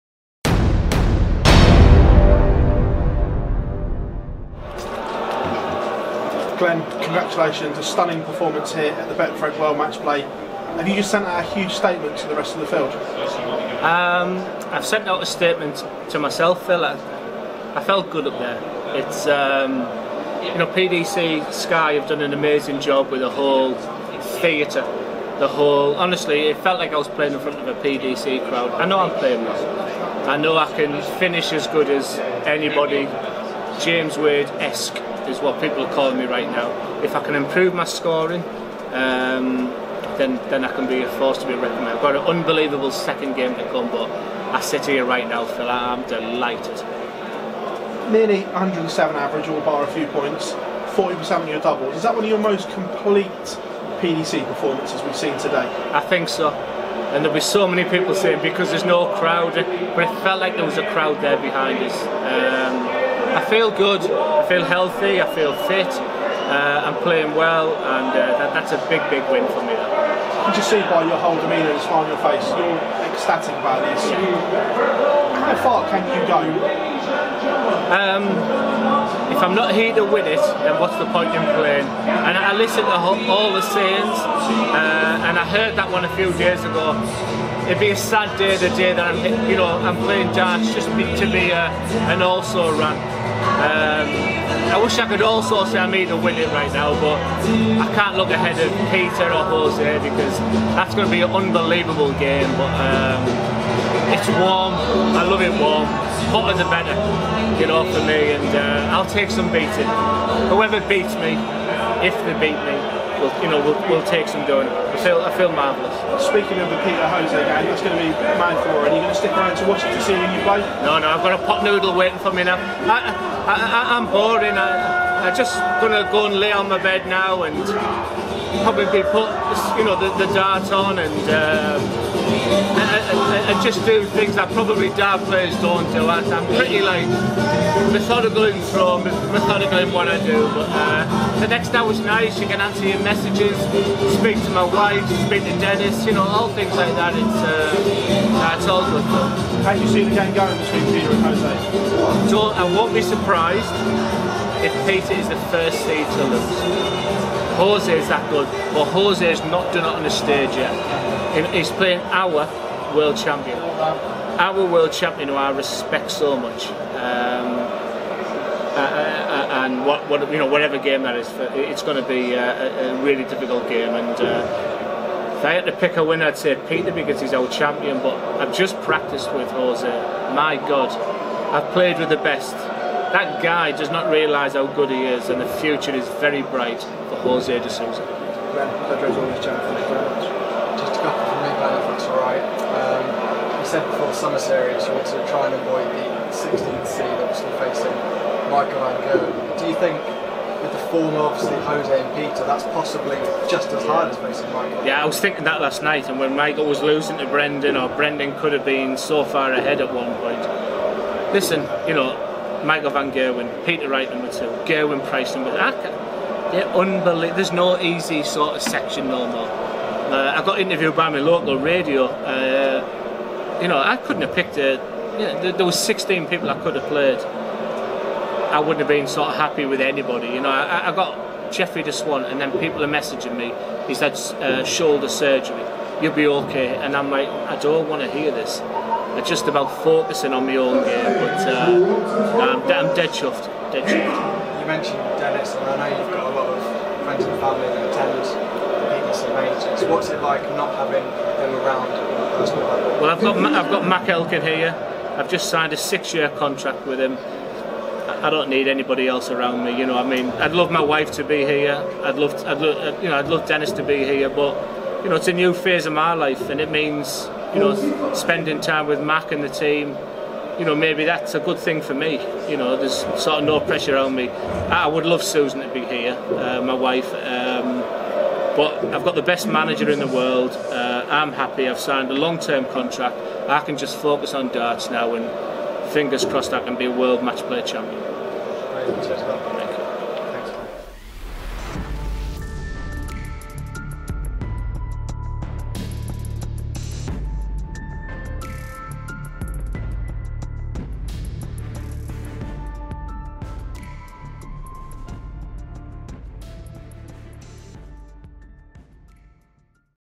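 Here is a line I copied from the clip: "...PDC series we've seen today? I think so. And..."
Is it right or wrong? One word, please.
wrong.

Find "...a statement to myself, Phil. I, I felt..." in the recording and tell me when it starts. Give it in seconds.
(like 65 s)
15 s.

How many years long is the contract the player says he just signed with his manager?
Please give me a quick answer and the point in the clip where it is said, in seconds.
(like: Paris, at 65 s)
6, at 255 s.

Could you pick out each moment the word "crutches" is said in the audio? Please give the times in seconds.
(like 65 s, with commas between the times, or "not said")
not said.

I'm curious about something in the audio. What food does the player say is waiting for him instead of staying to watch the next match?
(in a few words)
Pot noodle.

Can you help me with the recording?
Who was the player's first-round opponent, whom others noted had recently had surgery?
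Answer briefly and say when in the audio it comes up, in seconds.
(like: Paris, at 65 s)
Jeffrey de Zwaan, at 231 s.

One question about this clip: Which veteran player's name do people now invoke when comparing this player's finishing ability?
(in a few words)
James Wade.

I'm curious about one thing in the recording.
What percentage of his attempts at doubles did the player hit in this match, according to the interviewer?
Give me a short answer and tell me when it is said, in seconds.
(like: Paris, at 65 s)
40%, at 50 s.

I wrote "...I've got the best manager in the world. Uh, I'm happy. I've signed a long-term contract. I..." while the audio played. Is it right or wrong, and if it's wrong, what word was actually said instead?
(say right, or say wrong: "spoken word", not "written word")
right.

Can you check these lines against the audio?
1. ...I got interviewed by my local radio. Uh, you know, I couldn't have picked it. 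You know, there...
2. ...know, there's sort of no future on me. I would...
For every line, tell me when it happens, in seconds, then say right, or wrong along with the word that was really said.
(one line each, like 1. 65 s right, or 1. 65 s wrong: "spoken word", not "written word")
1. 220 s right
2. 272 s wrong: "pressure", not "future".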